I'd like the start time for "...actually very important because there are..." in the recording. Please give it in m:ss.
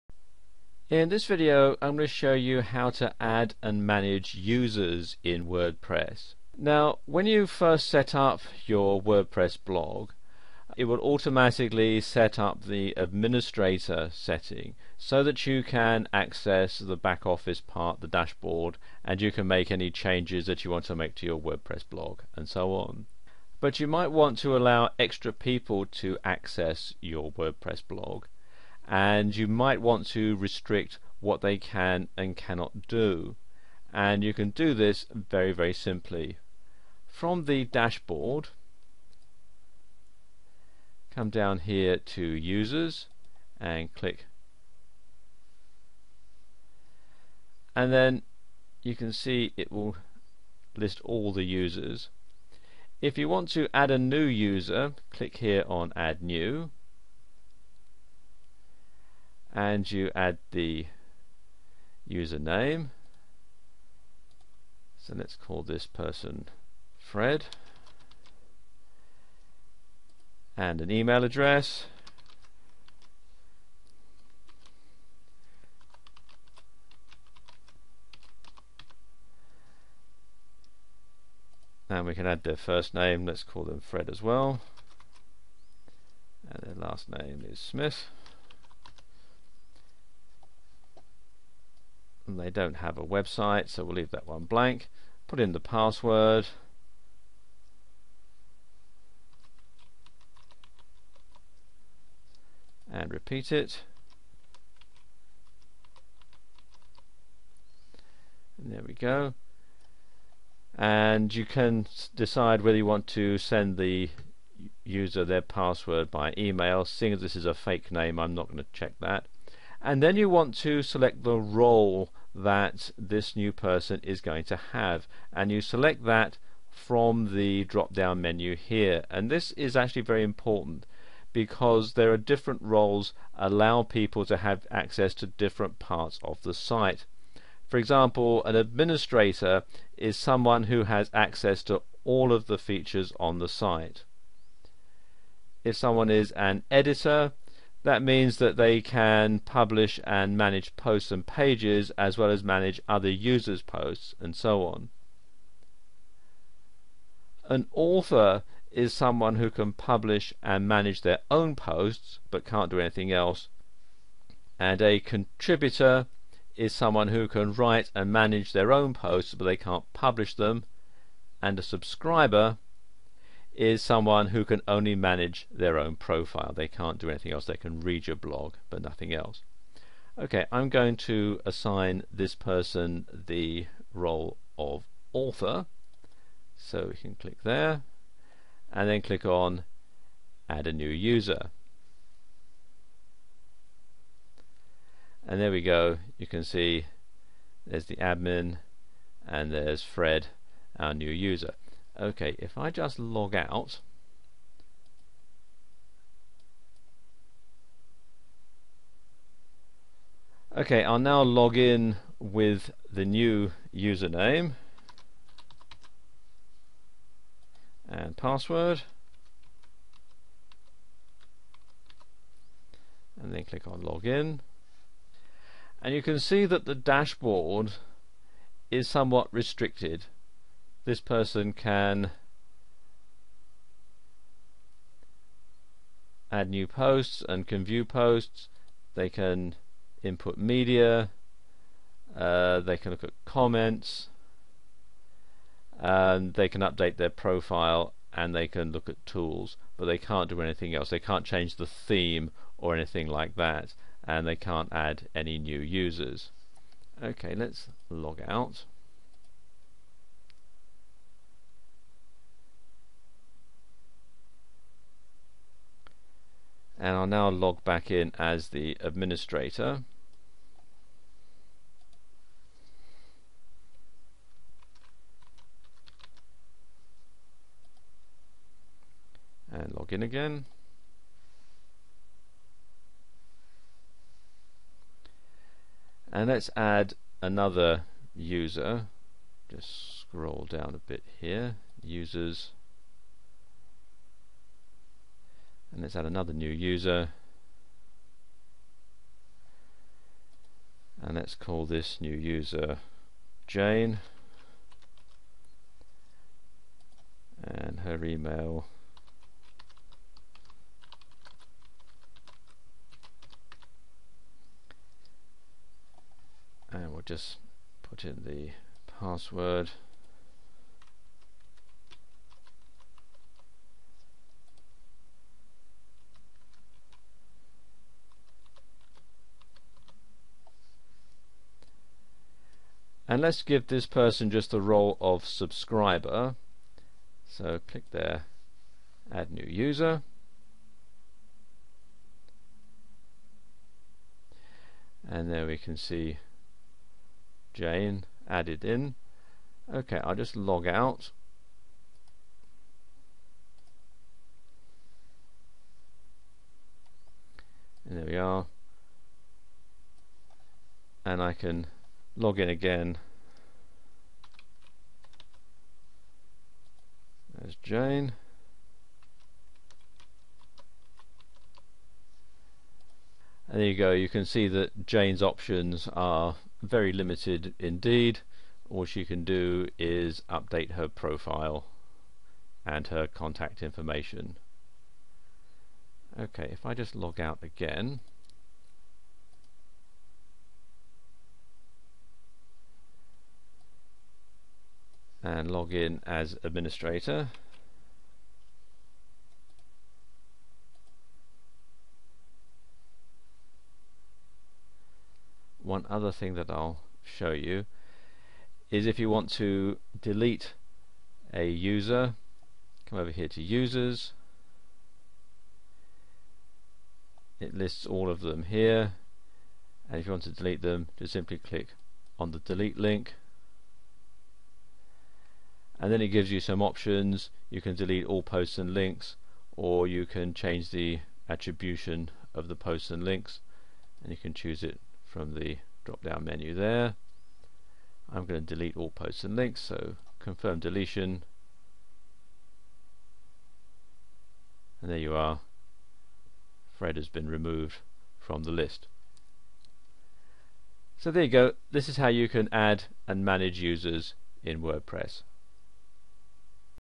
2:09.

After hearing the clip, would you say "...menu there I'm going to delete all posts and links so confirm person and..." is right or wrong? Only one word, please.
wrong.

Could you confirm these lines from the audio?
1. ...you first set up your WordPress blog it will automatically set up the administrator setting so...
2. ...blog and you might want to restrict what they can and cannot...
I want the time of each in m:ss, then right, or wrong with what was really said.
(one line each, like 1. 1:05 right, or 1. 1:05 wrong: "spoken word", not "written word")
1. 0:07 right
2. 0:27 right.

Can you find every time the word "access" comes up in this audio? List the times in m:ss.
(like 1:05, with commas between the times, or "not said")
0:16, 0:26, 2:14, 2:21.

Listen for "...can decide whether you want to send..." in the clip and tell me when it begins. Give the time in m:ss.
1:51.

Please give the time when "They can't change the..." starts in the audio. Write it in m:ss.
4:10.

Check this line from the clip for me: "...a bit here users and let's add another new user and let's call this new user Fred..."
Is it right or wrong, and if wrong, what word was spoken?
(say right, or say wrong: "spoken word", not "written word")
wrong: "Jane", not "Fred".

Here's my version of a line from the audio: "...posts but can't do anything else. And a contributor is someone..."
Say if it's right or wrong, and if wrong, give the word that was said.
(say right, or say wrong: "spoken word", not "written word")
right.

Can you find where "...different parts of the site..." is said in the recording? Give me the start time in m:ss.
2:15.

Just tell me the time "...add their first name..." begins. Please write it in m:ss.
1:22.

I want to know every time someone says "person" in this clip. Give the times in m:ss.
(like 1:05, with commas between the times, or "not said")
1:05, 2:03, 3:02, 3:51, 5:33.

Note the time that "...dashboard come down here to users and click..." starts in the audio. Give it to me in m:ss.
0:37.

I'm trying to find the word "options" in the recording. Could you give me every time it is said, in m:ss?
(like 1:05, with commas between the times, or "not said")
6:15, 7:06.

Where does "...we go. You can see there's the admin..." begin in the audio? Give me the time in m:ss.
3:15.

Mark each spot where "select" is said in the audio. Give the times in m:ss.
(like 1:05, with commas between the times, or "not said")
2:00, 2:05.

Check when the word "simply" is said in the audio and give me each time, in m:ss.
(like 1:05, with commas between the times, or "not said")
0:35, 7:01.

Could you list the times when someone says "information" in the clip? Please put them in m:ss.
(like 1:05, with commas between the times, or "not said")
6:23.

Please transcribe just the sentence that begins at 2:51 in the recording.
And a subscriber is someone who can only manage their own profile.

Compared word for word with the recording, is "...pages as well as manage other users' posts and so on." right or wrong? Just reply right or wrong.
right.